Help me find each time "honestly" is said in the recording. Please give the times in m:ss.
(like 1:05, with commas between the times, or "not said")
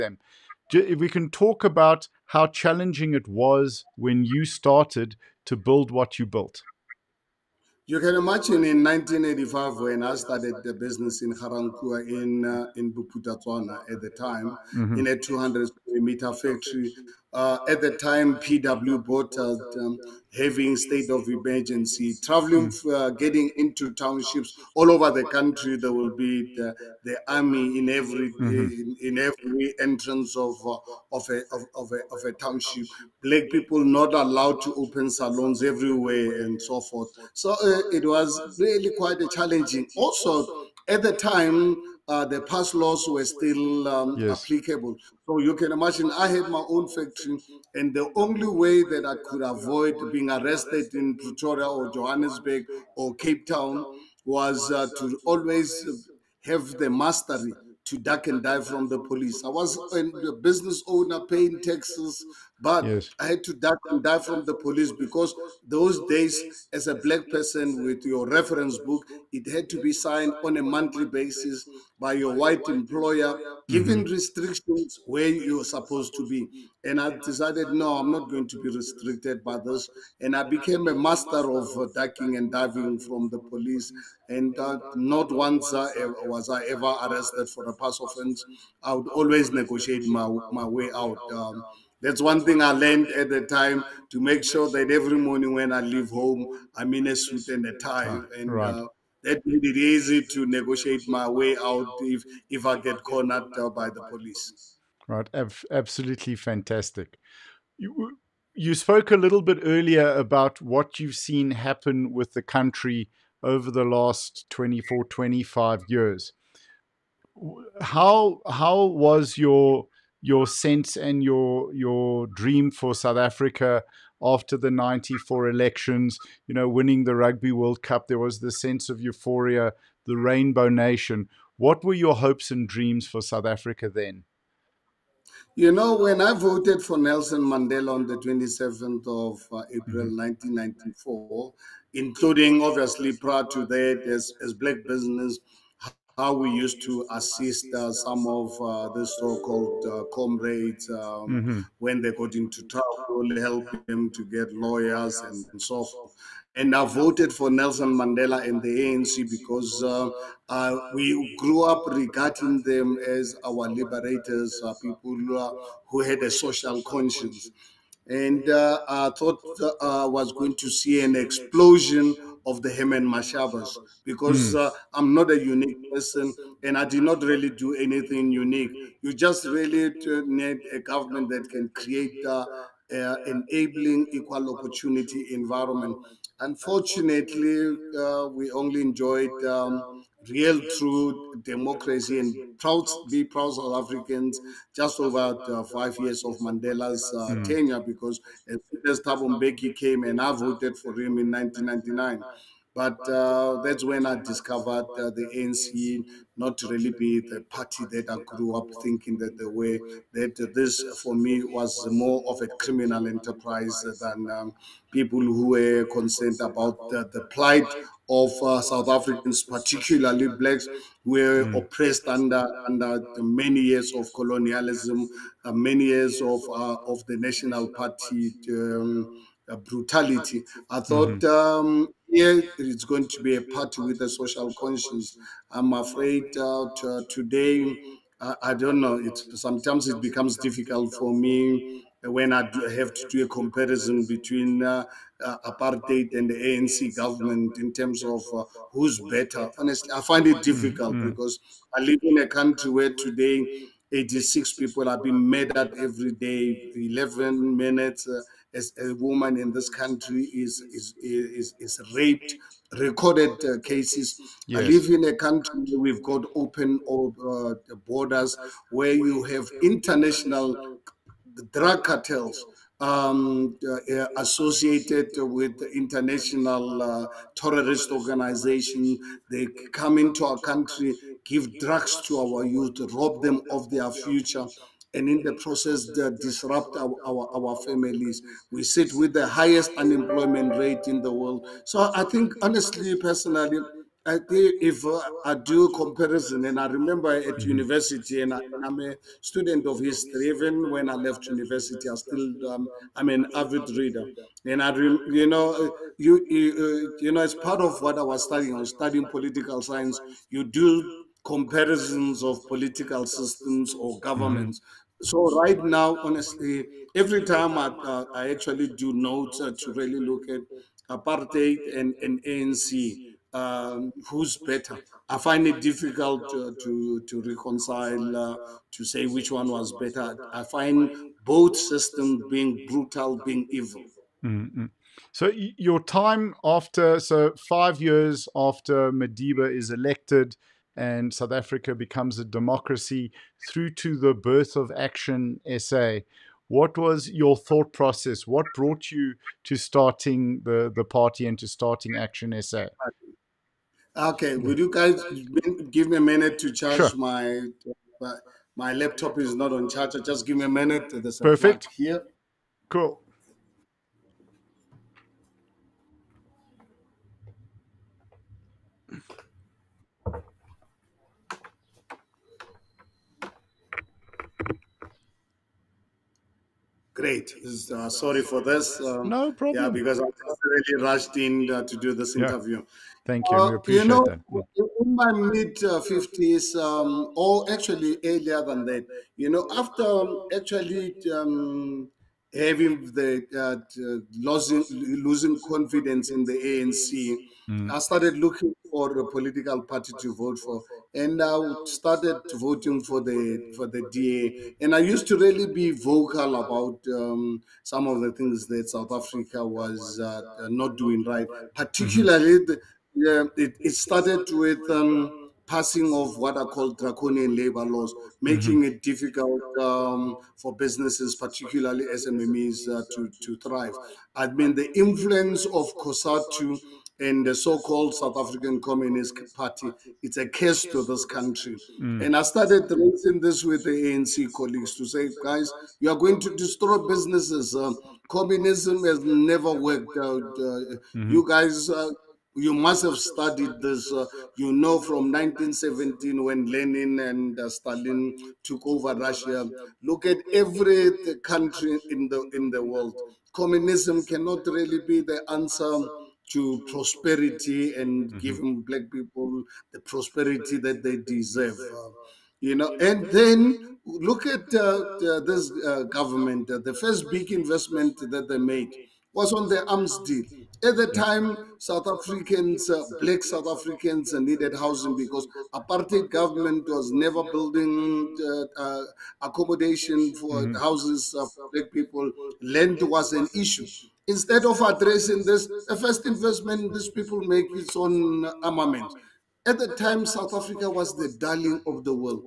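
4:09, 4:52, 5:16.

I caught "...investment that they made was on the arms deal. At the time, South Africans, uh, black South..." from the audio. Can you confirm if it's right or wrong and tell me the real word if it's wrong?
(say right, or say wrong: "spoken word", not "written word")
right.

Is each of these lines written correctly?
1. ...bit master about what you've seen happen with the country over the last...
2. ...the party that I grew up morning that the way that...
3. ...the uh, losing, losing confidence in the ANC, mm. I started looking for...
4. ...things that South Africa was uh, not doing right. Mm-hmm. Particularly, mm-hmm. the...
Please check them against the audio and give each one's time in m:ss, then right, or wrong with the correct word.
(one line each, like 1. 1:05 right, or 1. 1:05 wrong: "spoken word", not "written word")
1. 1:49 wrong: "earlier", not "master"
2. 3:27 wrong: "thinking", not "morning"
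3. 6:32 right
4. 6:48 right.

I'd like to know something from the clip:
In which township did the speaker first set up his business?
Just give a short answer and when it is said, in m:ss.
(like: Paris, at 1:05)
Ga-Rankuwa, at 0:11.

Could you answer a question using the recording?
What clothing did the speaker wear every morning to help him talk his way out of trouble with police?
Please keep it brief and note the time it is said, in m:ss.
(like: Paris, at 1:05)
A suit and a tie, at 1:37.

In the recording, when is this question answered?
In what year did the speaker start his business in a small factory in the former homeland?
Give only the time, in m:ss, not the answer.
0:08.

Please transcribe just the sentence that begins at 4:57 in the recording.
university, and, I, am a student of history.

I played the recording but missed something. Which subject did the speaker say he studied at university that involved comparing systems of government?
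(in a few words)
Political science.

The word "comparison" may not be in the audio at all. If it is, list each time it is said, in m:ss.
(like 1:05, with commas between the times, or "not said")
4:03, 4:55, 5:11.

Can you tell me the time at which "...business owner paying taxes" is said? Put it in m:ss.
1:00.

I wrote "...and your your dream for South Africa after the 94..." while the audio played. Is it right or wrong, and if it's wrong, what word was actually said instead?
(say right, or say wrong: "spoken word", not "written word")
right.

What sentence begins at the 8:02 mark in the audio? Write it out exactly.
Land was an issue instead of addressing this, the first investment these people make is on armament.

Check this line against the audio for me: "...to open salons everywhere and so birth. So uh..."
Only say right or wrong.
wrong.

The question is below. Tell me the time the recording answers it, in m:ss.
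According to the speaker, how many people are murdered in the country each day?
4:13.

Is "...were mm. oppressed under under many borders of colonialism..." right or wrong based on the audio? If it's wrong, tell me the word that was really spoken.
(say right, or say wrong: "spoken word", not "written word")
wrong: "years", not "borders".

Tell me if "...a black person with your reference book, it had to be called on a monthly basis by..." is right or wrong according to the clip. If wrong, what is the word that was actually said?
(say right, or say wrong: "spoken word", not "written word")
wrong: "signed", not "called".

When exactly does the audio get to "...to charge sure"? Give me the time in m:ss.
5:56.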